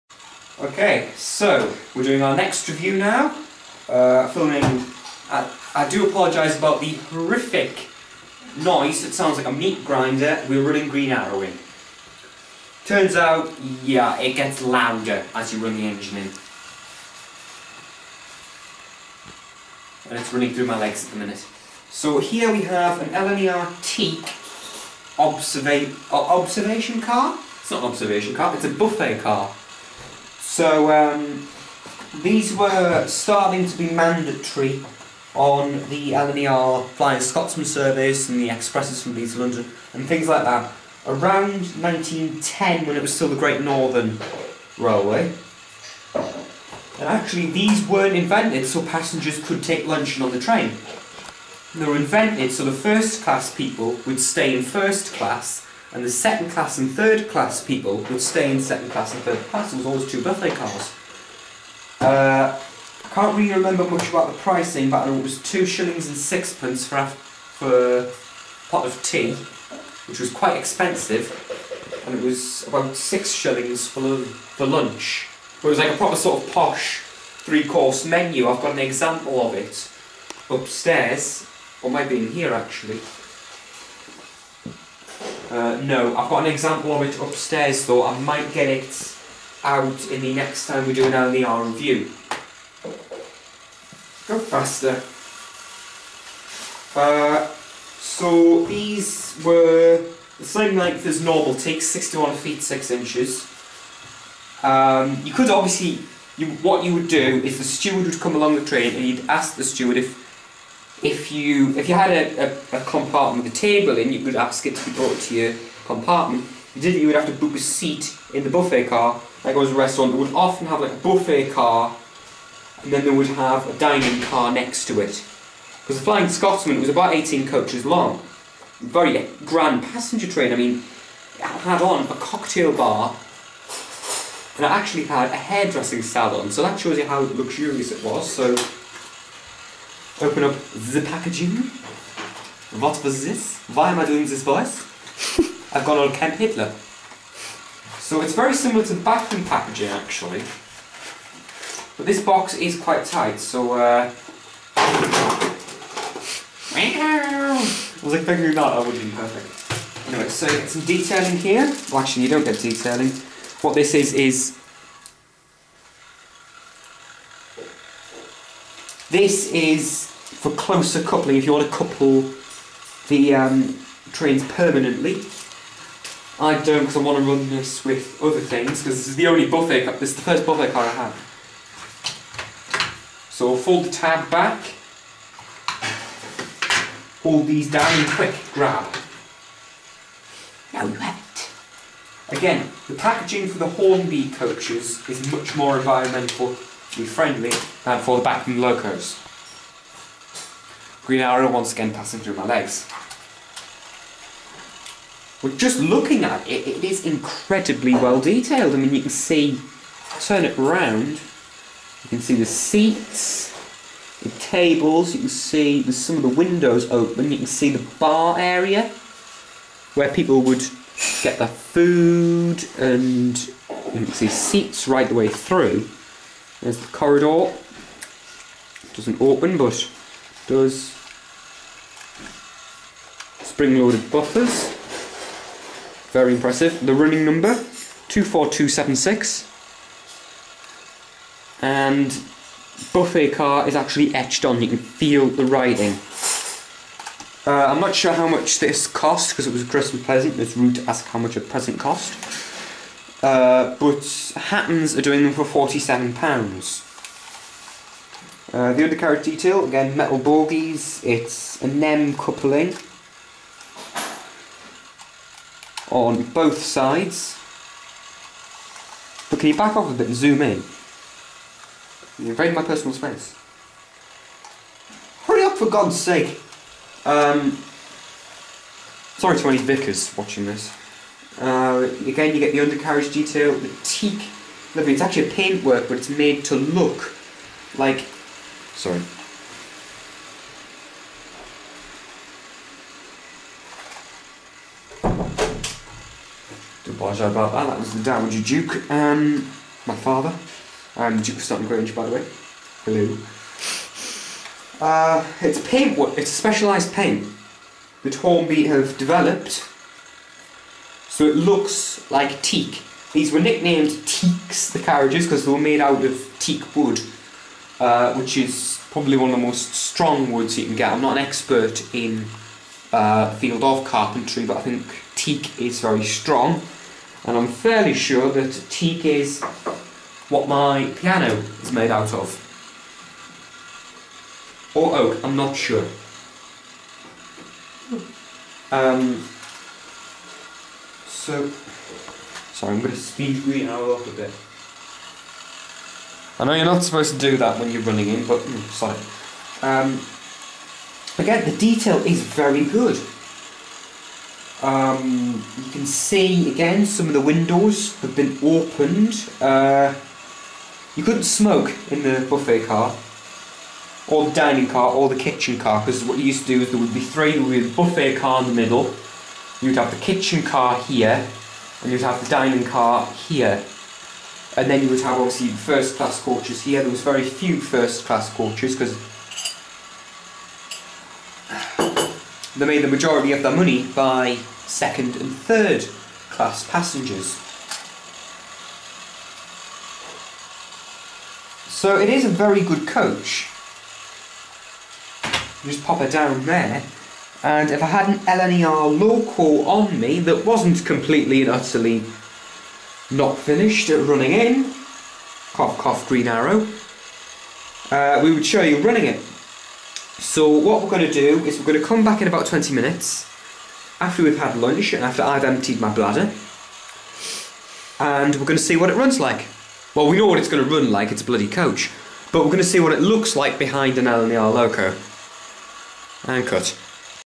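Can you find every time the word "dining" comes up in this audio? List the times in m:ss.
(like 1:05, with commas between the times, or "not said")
2:03, 6:04, 6:12.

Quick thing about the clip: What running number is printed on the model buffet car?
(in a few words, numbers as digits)
24276.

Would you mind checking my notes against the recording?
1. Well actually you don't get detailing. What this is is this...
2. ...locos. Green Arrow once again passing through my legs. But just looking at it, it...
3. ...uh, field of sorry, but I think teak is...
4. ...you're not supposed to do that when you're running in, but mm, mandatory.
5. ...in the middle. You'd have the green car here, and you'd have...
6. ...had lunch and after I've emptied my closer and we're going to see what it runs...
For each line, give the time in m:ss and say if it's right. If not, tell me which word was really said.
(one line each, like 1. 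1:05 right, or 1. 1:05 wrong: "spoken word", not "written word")
1. 2:41 right
2. 3:18 right
3. 5:22 wrong: "carpentry", not "sorry"
4. 5:46 wrong: "sorry", not "mandatory"
5. 6:08 wrong: "kitchen", not "green"
6. 6:54 wrong: "bladder", not "closer".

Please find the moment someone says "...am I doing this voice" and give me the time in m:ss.
2:23.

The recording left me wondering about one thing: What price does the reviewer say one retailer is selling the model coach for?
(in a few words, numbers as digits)
£47.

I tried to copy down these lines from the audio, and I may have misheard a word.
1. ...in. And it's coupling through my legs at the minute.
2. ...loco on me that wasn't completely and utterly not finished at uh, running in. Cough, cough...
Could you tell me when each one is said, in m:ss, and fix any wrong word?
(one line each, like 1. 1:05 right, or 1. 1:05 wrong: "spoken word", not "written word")
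1. 0:16 wrong: "running", not "coupling"
2. 6:38 right.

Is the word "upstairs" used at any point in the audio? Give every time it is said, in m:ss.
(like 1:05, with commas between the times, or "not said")
1:20, 1:27.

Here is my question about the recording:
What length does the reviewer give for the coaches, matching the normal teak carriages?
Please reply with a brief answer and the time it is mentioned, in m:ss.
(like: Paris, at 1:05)
61 feet 6 inches, at 1:41.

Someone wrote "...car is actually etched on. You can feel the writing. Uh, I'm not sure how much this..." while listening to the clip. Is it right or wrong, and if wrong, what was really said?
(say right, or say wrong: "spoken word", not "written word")
right.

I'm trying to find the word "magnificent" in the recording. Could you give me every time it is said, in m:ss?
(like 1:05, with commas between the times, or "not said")
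not said.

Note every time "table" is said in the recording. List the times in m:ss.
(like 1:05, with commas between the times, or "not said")
1:53, 3:34.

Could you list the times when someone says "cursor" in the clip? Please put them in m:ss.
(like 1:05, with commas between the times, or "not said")
not said.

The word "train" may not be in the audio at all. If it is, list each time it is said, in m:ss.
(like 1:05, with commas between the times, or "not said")
0:50, 1:48, 2:10, 2:54.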